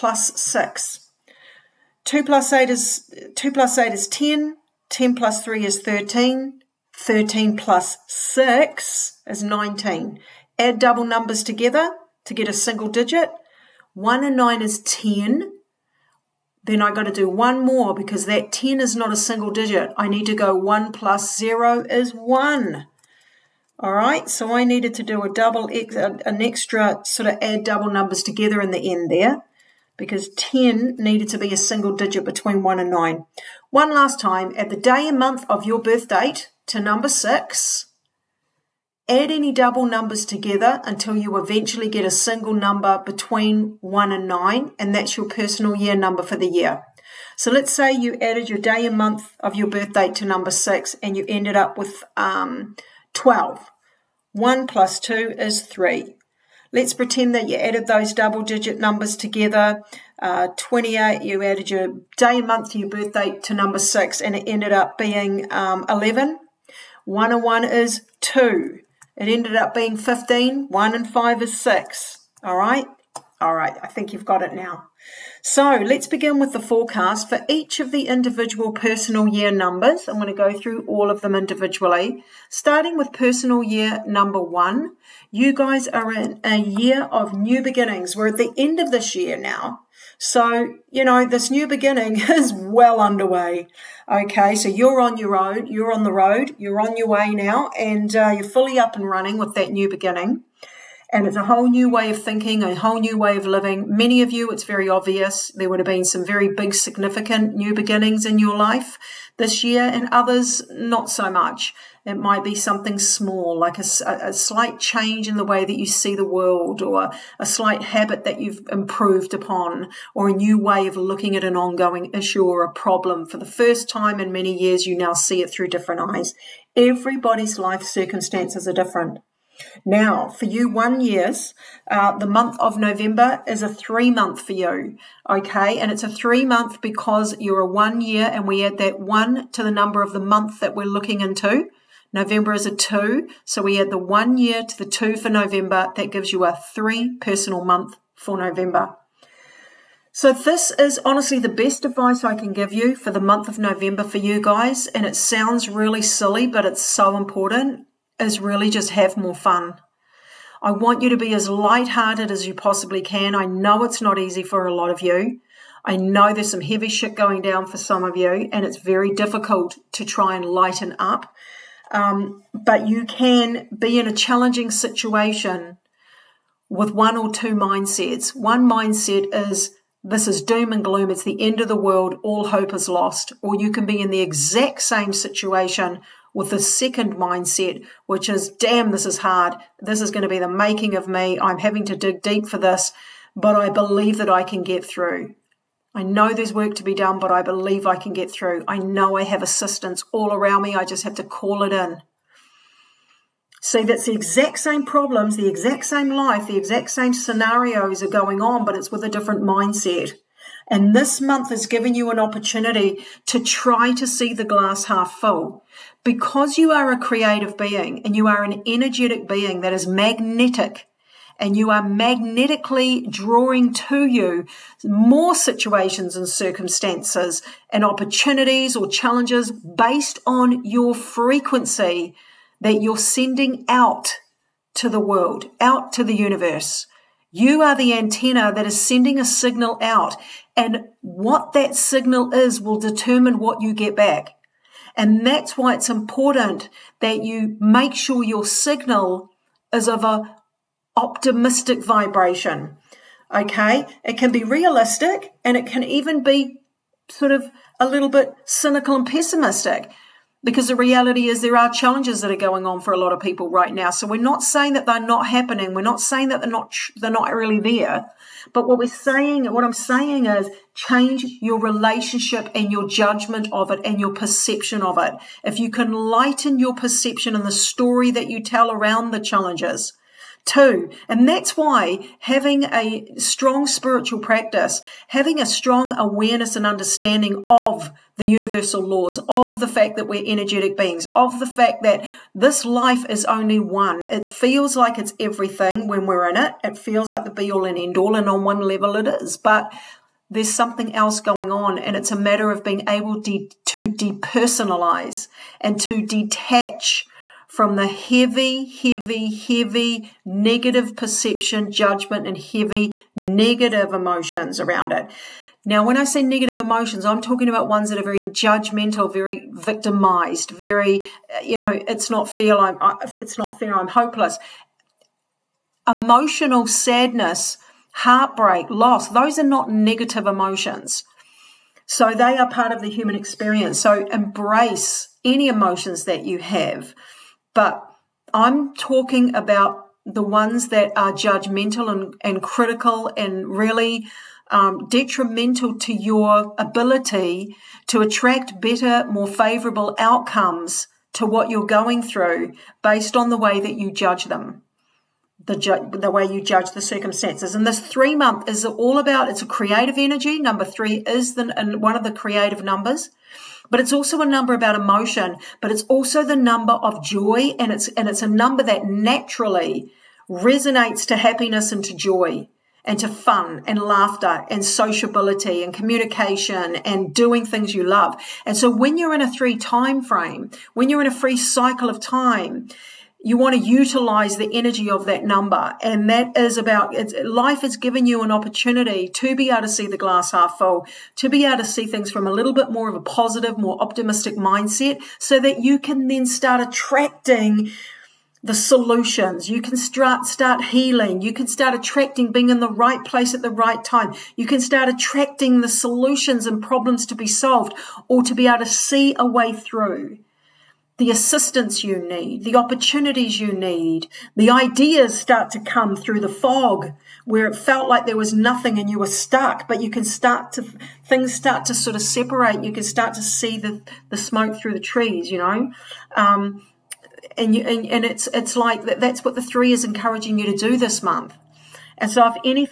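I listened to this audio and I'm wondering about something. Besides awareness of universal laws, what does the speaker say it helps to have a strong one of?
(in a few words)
Spiritual practice.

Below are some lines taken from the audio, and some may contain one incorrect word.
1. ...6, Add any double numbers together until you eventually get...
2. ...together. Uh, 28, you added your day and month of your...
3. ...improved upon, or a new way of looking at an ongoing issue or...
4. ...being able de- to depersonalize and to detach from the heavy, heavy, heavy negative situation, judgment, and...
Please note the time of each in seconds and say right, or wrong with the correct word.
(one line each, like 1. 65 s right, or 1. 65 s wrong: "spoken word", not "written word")
1. 37 s right
2. 59 s right
3. 118 s right
4. 302 s wrong: "perception", not "situation".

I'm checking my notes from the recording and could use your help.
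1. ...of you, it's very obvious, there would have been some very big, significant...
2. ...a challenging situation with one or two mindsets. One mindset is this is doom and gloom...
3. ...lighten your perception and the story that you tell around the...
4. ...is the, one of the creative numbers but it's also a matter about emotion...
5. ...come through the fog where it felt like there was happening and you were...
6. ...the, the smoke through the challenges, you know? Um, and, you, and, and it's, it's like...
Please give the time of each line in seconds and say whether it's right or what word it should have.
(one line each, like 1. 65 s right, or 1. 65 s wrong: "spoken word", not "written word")
1. 104 s right
2. 174 s right
3. 275 s right
4. 360 s wrong: "number", not "matter"
5. 415 s wrong: "nothing", not "happening"
6. 423 s wrong: "trees", not "challenges".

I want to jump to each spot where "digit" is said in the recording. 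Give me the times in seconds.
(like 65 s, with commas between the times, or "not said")
12 s, 19 s, 31 s, 58 s.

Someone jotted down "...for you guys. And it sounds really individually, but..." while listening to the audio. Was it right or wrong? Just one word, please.
wrong.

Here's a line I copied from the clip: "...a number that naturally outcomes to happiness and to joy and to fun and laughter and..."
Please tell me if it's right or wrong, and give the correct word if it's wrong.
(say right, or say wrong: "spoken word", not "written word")
wrong: "resonates", not "outcomes".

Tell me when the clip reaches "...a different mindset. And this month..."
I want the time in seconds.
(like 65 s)
209 s.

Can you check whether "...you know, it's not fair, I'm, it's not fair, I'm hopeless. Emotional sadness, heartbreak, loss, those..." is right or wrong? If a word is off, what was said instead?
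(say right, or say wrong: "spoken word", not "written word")
right.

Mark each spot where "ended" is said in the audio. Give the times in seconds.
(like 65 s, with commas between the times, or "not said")
51 s, 64 s, 69 s.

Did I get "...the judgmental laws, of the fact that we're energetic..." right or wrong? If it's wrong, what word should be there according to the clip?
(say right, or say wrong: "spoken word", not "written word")
wrong: "universal", not "judgmental".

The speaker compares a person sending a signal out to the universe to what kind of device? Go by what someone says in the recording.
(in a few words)
Antenna.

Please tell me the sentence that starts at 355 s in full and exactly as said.
The, ju- the way you judge the circumstances.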